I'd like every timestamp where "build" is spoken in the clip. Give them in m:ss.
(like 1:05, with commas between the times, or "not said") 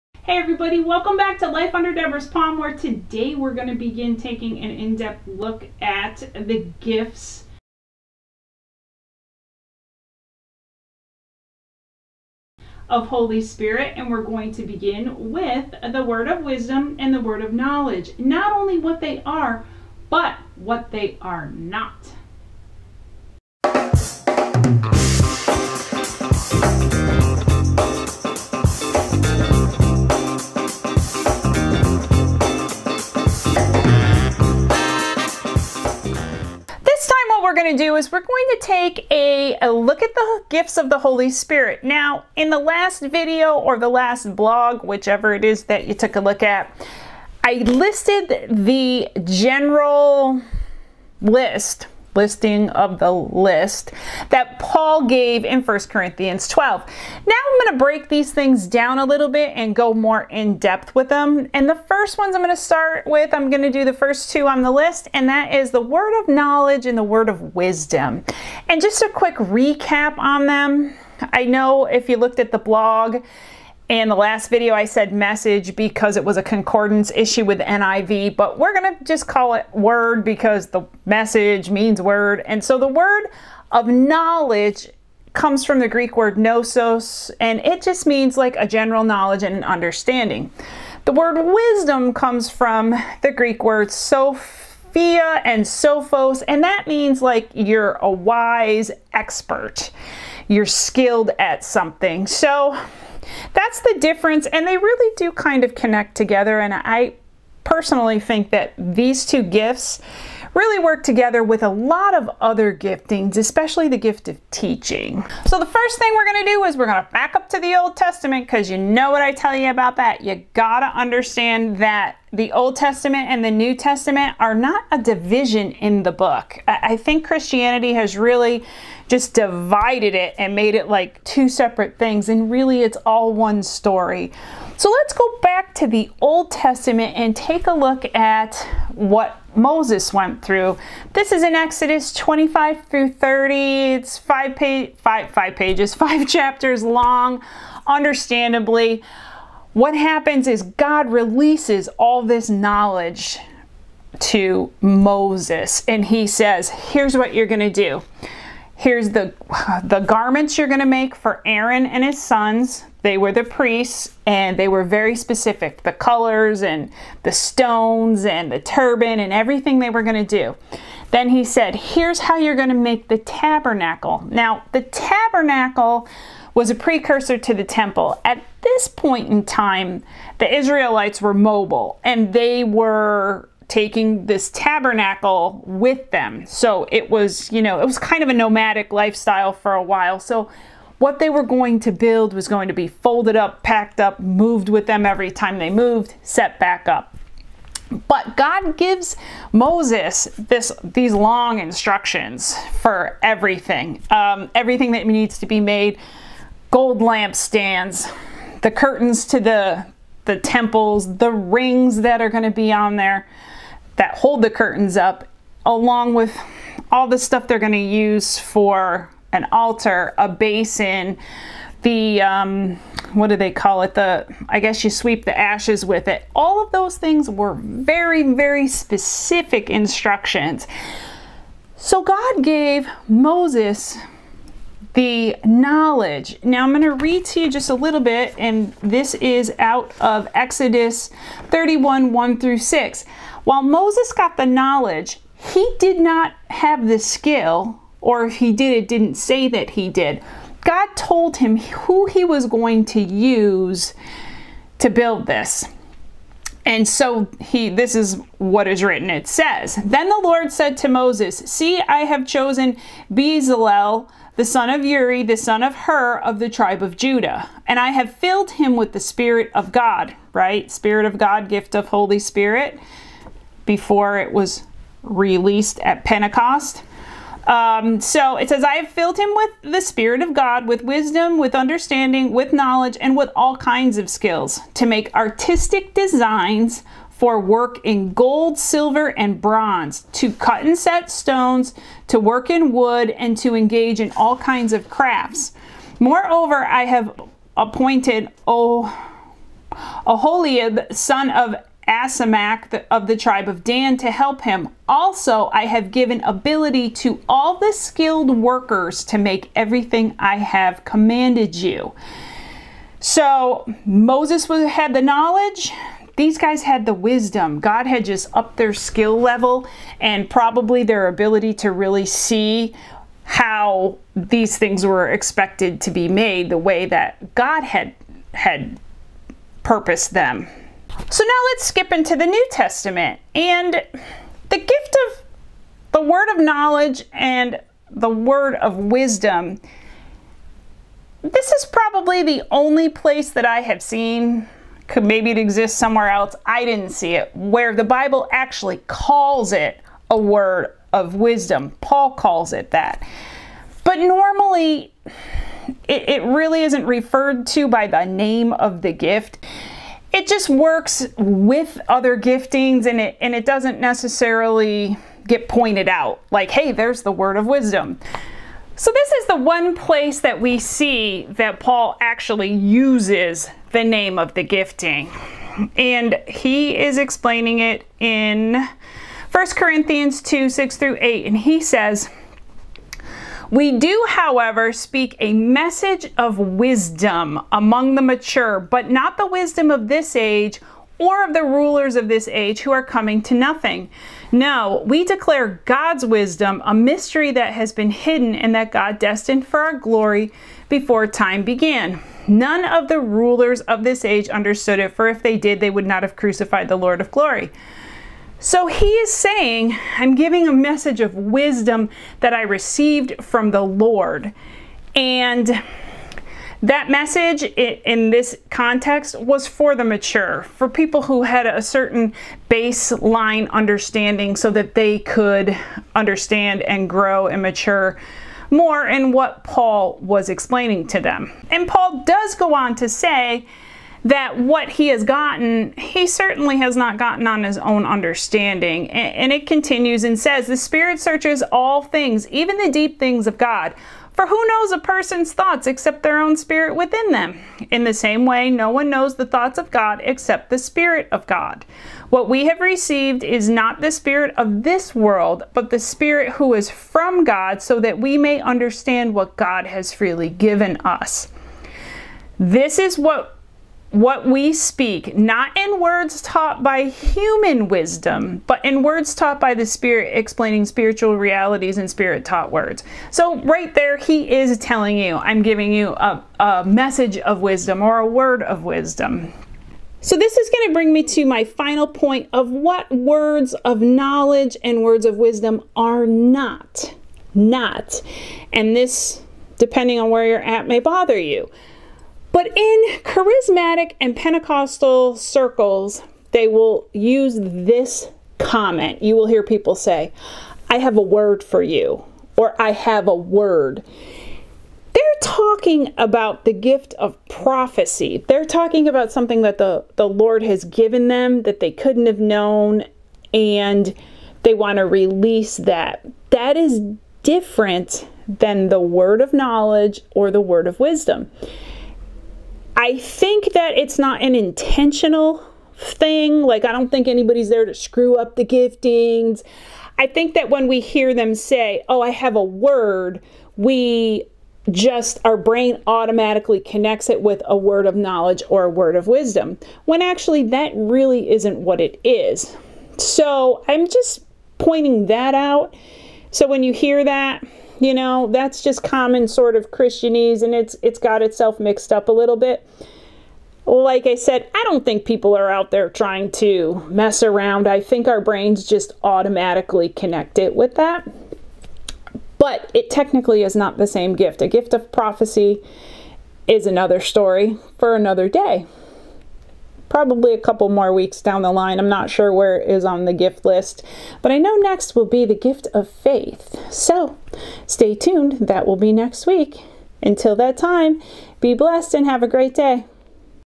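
3:11, 4:14.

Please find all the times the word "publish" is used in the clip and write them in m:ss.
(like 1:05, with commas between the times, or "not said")
not said.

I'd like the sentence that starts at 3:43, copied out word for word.
The I guess you sweep the ashes with it.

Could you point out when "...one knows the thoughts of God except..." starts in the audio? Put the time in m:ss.
7:28.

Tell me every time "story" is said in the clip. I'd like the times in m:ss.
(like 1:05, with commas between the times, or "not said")
2:13, 9:26.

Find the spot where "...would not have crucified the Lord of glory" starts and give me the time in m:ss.
6:45.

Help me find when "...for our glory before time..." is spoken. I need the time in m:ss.
6:39.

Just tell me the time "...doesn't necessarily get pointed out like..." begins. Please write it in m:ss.
6:03.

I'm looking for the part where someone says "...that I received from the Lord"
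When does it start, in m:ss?
6:52.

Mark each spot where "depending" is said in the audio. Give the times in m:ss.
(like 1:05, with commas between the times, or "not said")
8:09.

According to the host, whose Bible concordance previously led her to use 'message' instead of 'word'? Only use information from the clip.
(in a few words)
NIV.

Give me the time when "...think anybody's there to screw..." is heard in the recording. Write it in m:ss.
8:46.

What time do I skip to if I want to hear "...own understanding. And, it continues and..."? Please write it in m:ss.
7:17.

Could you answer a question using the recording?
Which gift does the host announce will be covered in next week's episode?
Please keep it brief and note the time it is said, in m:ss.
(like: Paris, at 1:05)
gift of faith, at 9:35.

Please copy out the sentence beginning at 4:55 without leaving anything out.
Moreover, I have appointed oh, Aholiab, son of Asamach of the tribe of Dan to help him.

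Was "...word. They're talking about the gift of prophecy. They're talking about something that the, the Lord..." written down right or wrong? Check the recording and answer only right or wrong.
right.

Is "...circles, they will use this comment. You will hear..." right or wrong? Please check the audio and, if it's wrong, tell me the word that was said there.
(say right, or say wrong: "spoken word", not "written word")
right.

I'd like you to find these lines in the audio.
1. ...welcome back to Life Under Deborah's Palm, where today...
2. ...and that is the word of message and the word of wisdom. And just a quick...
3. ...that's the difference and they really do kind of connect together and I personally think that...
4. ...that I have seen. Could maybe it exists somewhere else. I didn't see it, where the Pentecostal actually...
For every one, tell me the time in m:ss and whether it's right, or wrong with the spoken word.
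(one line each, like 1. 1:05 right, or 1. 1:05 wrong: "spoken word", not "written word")
1. 0:00 right
2. 1:05 wrong: "knowledge", not "message"
3. 1:43 right
4. 5:43 wrong: "Bible", not "Pentecostal".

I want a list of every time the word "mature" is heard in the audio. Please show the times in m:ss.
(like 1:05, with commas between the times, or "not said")
6:28, 6:59, 7:07.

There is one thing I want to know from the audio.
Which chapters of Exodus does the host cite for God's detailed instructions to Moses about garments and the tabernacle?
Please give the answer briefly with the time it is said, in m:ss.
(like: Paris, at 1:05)
Exodus 25 through 30, at 2:21.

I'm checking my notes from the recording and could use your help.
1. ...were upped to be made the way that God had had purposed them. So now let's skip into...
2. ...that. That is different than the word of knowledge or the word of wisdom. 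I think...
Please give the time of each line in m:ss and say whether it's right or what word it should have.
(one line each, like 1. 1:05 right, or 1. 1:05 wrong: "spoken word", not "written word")
1. 5:24 wrong: "expected", not "upped"
2. 8:35 right.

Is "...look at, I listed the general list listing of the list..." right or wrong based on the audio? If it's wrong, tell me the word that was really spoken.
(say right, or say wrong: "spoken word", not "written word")
right.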